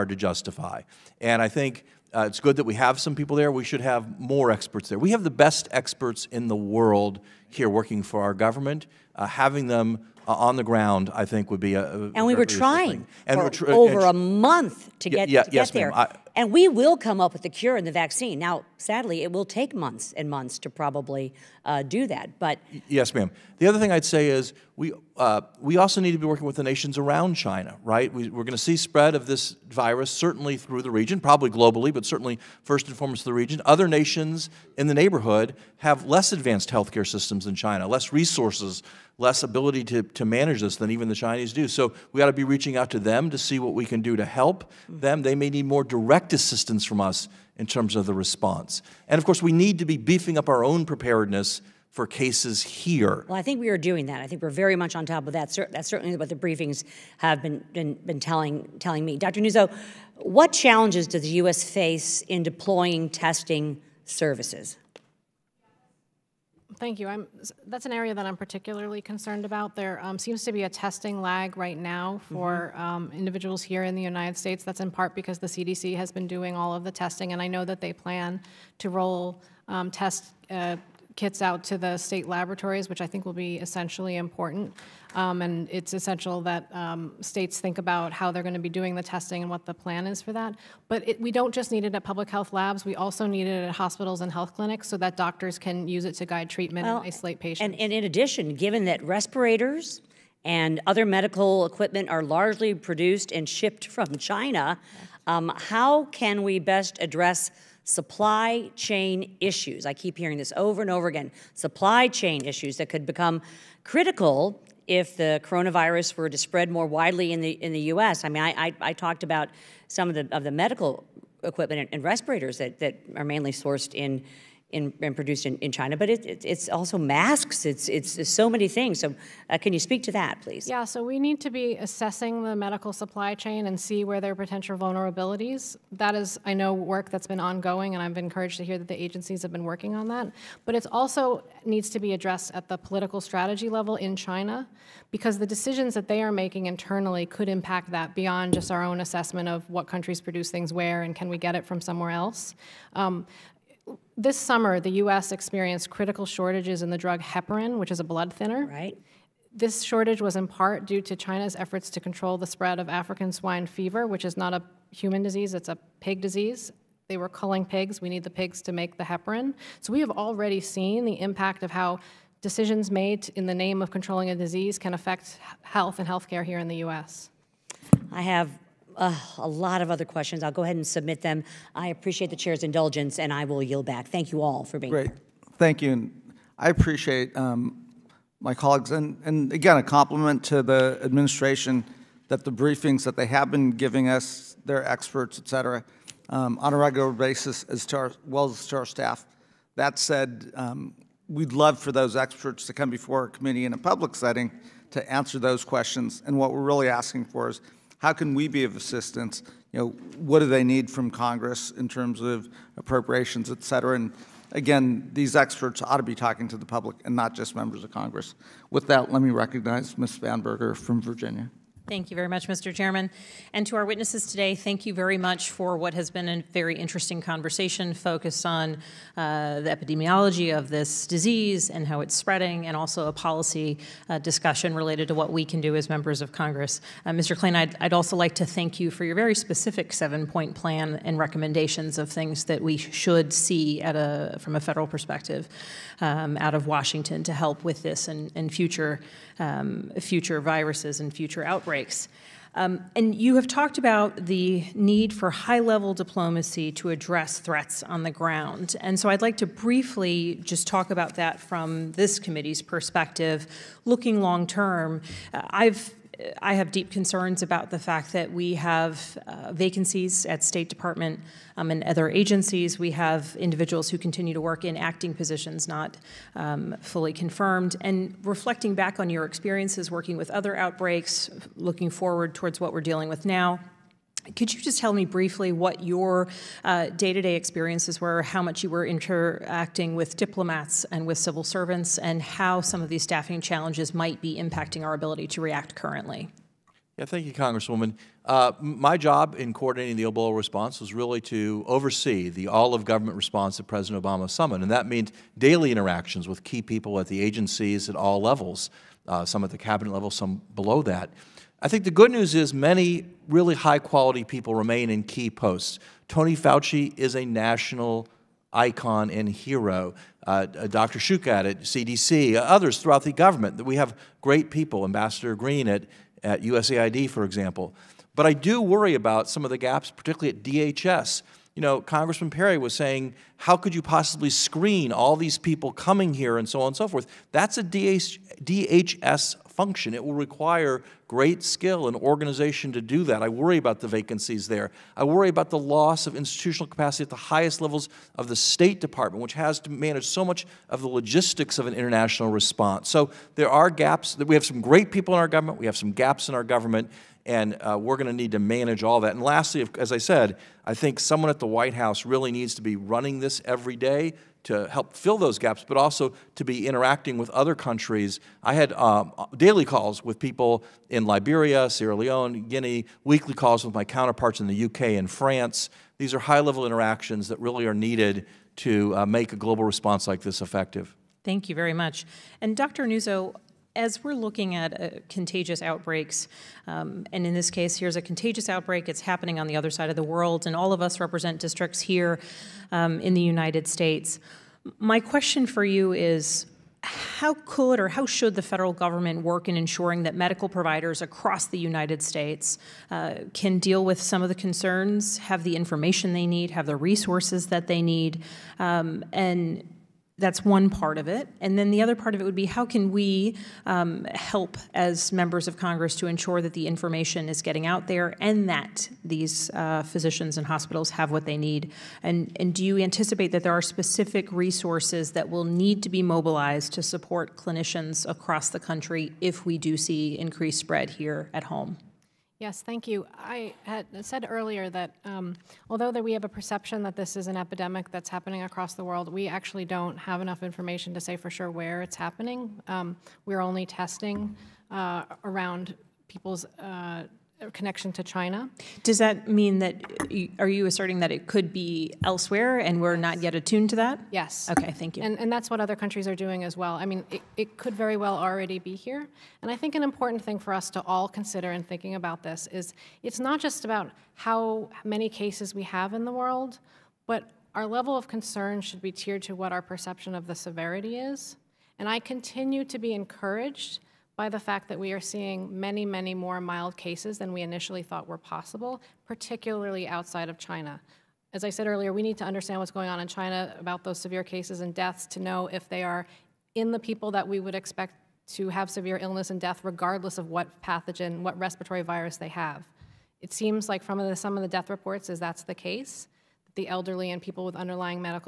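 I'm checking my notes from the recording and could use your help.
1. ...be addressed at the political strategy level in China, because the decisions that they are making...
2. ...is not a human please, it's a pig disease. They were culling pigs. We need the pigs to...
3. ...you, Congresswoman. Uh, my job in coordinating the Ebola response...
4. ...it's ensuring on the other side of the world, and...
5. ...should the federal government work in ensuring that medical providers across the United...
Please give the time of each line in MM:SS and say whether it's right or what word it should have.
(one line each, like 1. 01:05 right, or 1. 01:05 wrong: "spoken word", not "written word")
1. 02:21 right
2. 02:44 wrong: "disease", not "please"
3. 04:57 right
4. 06:28 wrong: "happening", not "ensuring"
5. 06:38 right.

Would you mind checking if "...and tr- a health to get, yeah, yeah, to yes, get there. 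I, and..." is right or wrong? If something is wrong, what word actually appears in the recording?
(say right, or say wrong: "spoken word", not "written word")
wrong: "month", not "health".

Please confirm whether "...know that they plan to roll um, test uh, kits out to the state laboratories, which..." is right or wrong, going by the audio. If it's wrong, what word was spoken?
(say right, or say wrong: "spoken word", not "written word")
right.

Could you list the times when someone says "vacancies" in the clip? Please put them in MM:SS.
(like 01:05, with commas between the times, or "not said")
04:29, 05:43.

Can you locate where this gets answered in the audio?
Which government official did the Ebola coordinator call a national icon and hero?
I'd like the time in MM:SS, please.
05:16.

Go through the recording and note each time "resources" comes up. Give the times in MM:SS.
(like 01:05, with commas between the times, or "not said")
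00:38, 06:46, 07:04.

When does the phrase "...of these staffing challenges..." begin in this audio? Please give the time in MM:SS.
04:52.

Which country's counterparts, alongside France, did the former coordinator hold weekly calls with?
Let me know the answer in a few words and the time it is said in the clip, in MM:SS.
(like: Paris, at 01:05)
UK, at 06:14.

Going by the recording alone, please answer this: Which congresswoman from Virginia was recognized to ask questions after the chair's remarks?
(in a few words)
Spanberger.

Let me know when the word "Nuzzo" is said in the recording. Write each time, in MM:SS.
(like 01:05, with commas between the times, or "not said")
00:59, 06:22.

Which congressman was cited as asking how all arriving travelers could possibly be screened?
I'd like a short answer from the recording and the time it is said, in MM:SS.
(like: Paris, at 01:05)
Perry, at 05:32.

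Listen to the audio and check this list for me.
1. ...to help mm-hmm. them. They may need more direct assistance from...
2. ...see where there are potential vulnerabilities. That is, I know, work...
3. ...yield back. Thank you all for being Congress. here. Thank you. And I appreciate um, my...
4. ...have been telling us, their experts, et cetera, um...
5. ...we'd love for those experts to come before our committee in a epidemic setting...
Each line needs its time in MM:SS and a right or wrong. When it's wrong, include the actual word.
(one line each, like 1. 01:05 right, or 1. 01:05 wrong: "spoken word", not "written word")
1. 00:44 right
2. 02:13 right
3. 03:03 wrong: "Great", not "Congress"
4. 03:13 wrong: "giving", not "telling"
5. 03:21 wrong: "public", not "epidemic".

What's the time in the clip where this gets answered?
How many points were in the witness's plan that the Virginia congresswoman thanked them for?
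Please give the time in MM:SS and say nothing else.
03:59.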